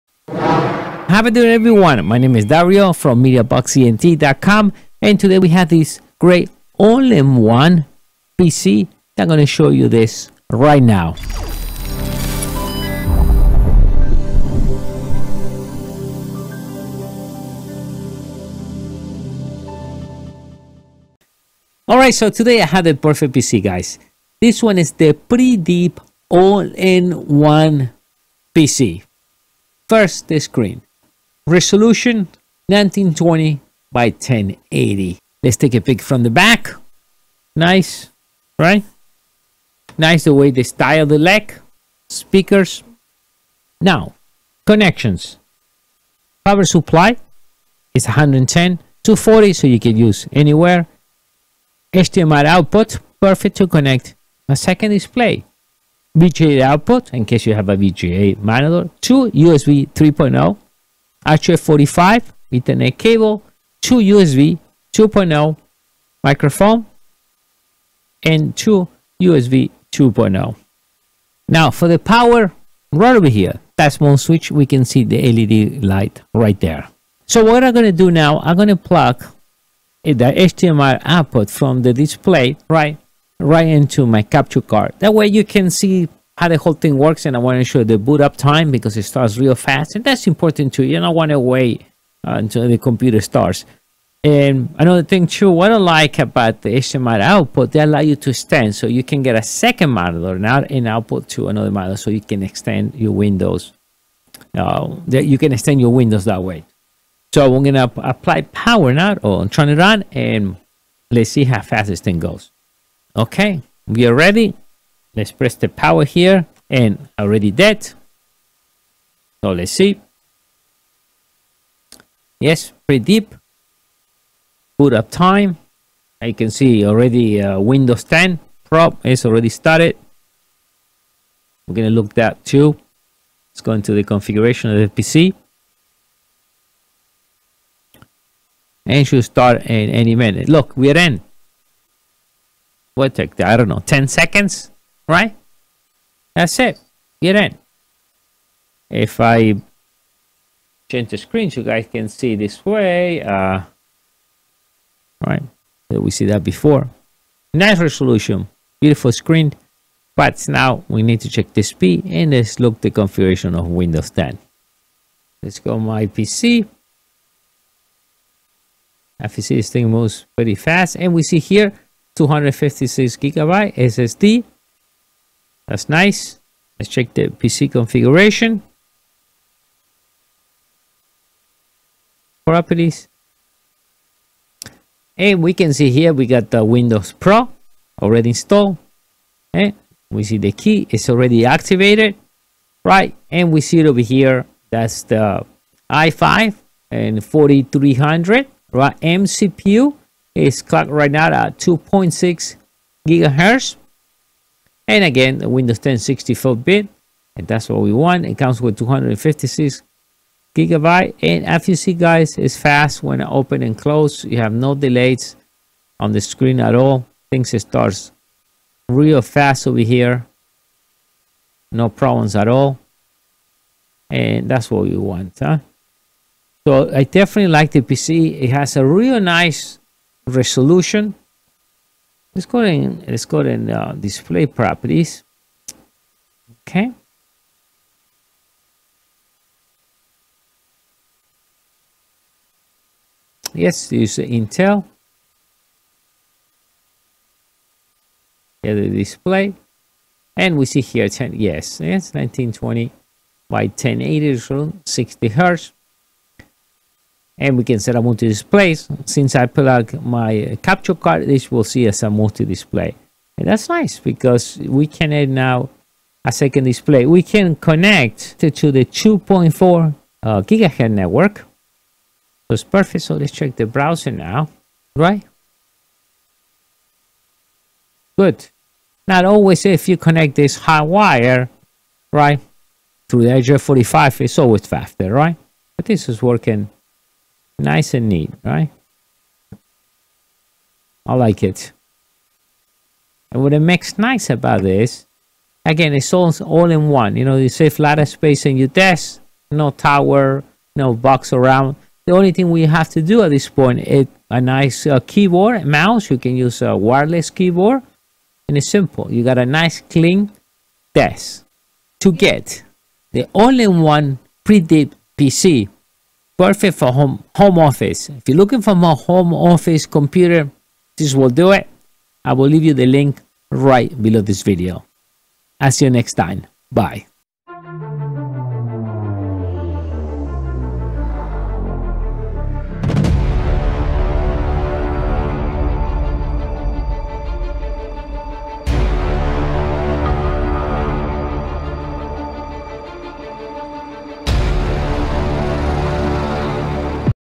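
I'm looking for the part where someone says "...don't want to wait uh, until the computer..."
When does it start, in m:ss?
1:30.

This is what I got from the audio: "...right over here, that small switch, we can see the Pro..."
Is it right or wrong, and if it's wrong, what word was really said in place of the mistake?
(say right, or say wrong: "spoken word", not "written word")
wrong: "LED", not "Pro".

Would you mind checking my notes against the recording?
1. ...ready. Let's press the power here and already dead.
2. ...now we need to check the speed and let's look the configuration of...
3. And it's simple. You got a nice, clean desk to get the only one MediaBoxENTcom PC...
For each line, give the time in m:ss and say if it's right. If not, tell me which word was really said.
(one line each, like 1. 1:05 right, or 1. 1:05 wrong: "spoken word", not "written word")
1. 1:54 right
2. 2:40 right
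3. 5:08 wrong: "Preedip", not "MediaBoxENTcom".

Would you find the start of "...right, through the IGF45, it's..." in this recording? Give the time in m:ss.
4:42.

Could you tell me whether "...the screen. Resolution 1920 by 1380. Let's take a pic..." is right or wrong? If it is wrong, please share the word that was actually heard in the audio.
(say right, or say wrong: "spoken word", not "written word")
wrong: "1080", not "1380".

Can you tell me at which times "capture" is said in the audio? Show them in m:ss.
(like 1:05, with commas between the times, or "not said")
1:24, 4:20.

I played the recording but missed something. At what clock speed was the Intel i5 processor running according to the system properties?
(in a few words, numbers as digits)
2.6 GHz.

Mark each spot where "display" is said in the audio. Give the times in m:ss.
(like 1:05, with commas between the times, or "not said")
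0:54, 1:21, 3:53, 4:08, 4:18, 4:22, 4:26.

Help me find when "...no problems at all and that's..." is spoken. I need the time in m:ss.
3:41.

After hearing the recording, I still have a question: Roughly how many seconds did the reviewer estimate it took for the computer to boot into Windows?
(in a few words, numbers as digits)
10 seconds.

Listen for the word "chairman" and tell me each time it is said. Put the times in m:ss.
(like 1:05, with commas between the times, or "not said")
not said.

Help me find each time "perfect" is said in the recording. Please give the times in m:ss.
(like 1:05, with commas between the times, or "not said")
0:22, 0:53, 4:32, 5:16.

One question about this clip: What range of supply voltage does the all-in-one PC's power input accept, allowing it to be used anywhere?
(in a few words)
110-240.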